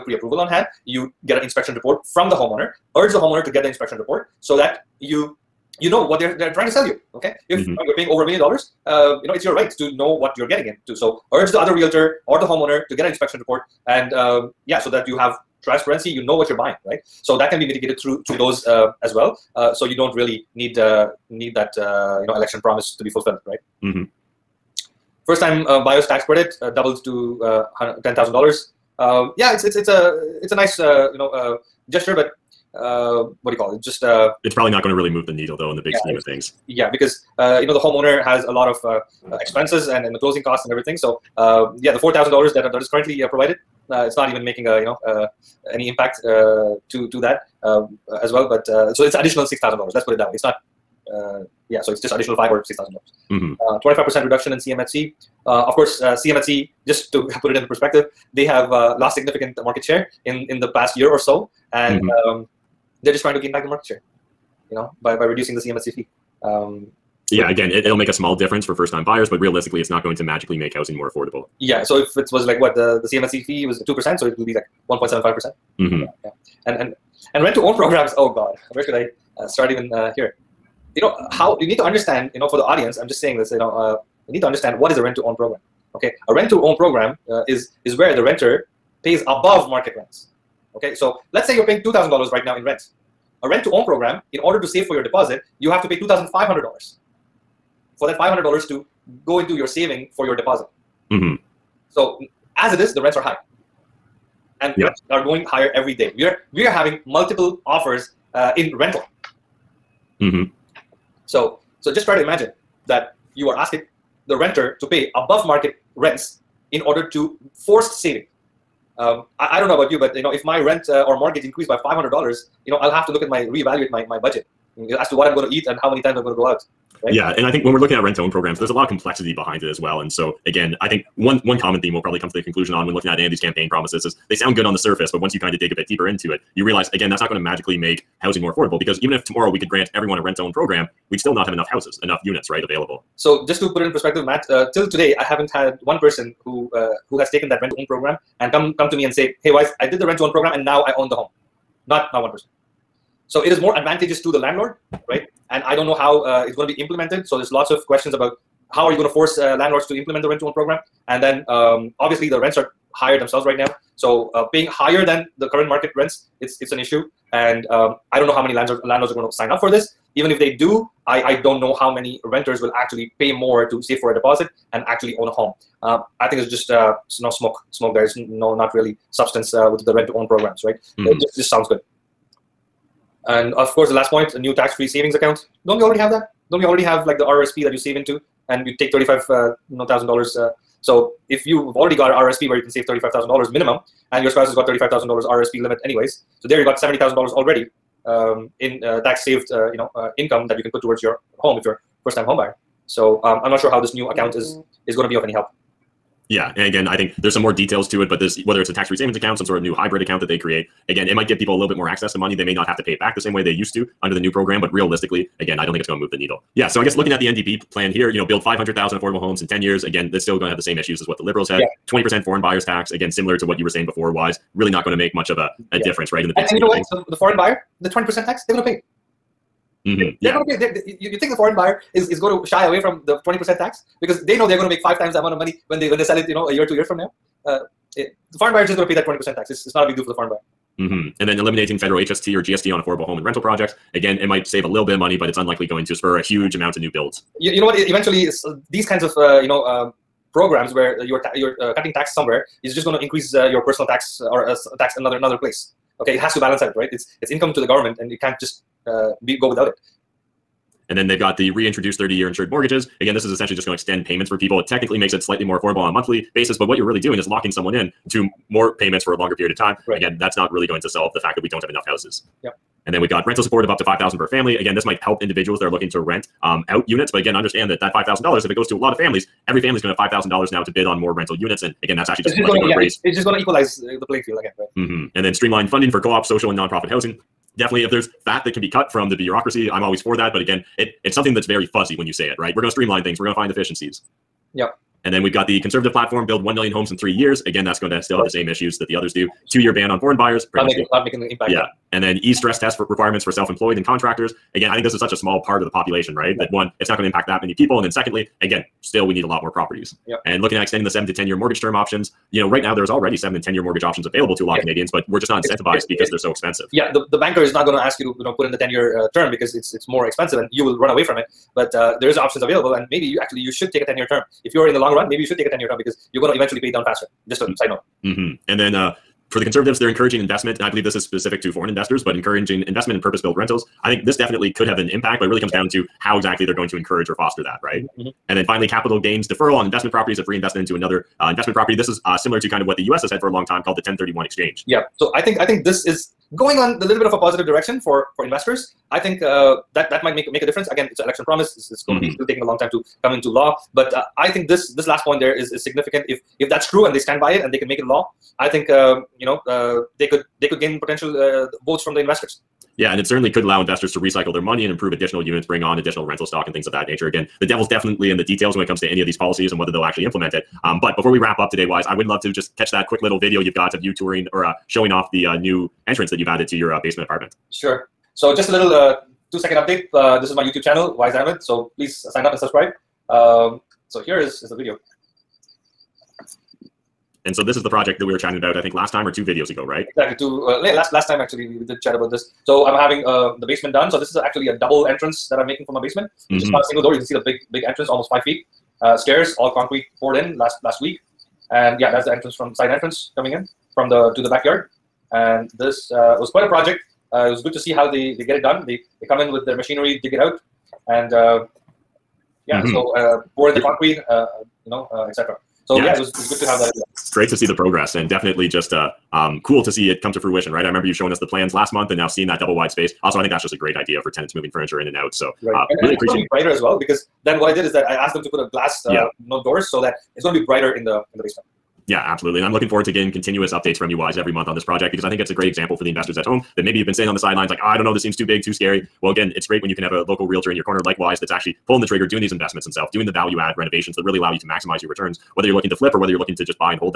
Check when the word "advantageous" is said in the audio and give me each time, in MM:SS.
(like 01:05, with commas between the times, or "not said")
02:33.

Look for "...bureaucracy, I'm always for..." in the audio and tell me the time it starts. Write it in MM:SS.
04:49.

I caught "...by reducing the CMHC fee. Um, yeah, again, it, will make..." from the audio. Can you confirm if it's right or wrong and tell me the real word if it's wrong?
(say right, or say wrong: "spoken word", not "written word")
right.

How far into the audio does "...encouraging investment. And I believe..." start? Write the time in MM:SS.
05:29.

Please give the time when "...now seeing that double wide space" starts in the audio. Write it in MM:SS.
07:01.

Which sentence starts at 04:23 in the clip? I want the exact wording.
Again, this is essentially just going to extend payments for people.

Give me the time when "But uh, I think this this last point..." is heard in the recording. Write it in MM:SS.
05:53.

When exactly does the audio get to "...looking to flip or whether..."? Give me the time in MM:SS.
07:25.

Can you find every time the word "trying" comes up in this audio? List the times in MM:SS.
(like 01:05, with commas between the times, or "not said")
00:06, 01:03.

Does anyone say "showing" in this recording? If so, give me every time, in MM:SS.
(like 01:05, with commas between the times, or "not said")
06:14, 07:00.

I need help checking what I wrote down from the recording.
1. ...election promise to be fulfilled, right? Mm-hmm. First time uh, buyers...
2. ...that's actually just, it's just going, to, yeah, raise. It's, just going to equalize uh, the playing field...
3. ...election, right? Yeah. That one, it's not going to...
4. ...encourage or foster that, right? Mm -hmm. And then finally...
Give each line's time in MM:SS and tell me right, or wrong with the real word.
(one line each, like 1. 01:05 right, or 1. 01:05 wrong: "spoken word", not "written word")
1. 00:22 right
2. 04:41 right
3. 05:05 wrong: "population", not "election"
4. 05:36 right.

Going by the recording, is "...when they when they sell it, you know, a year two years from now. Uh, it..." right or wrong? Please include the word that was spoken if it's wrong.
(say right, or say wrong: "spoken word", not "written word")
right.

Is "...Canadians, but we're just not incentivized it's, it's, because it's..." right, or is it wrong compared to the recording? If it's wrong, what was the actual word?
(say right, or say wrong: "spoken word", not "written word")
right.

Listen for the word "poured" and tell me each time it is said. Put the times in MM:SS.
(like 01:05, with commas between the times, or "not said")
06:40, 06:53.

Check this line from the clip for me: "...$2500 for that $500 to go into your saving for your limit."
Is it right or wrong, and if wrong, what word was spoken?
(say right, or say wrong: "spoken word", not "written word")
wrong: "deposit", not "limit".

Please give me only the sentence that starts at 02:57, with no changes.
Smoke there is no not really substance uh, with the rent to own programs, right?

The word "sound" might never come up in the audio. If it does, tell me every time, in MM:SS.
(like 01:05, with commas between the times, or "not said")
02:14, 03:01.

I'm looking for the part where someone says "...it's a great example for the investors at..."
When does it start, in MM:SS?
07:15.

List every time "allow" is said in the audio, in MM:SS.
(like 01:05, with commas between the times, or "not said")
06:03, 07:24.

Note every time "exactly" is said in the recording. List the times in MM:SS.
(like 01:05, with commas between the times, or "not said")
05:36, 06:29.